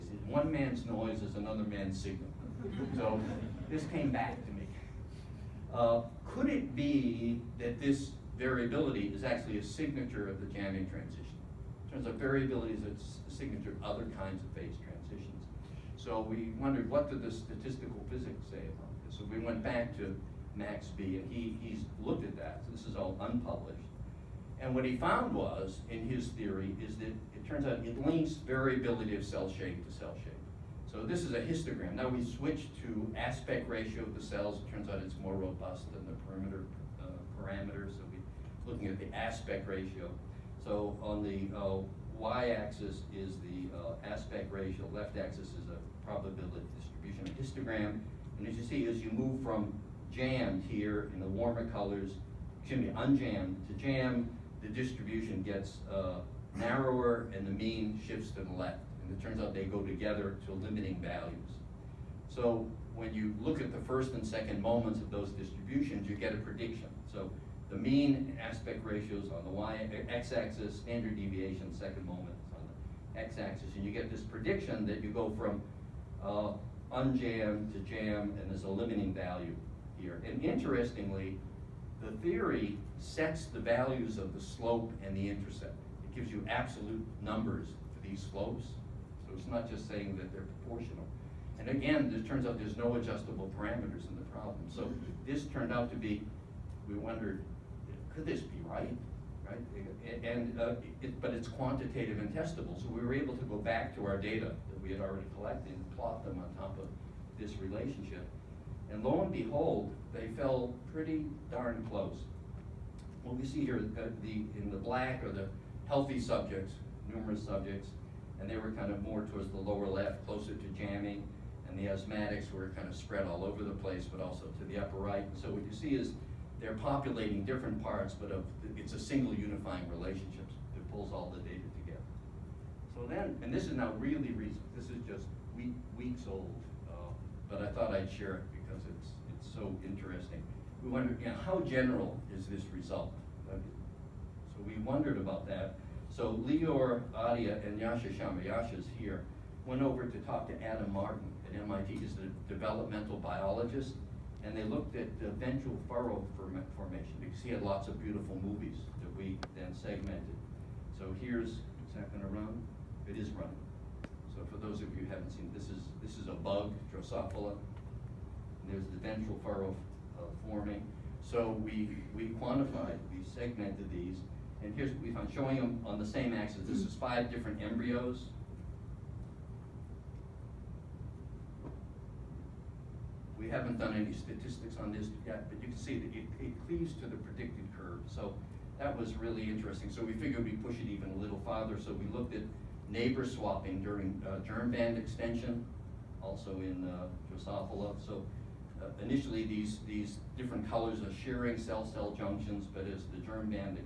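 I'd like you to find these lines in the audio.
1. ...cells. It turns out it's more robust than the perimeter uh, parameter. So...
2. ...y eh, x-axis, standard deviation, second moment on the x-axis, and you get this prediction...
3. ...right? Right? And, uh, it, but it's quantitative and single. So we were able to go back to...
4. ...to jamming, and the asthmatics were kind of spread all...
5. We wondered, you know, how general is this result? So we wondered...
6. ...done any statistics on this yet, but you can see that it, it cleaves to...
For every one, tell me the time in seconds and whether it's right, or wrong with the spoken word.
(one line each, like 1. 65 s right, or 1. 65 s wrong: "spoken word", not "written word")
1. 34 s right
2. 69 s right
3. 98 s wrong: "testable", not "single"
4. 120 s right
5. 140 s right
6. 183 s right.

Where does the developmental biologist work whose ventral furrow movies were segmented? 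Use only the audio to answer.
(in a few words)
MIT.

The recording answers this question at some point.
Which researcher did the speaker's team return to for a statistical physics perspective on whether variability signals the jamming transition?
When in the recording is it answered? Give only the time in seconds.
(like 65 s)
20 s.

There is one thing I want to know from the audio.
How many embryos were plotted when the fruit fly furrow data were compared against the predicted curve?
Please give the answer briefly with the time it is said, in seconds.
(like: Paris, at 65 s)
5, at 176 s.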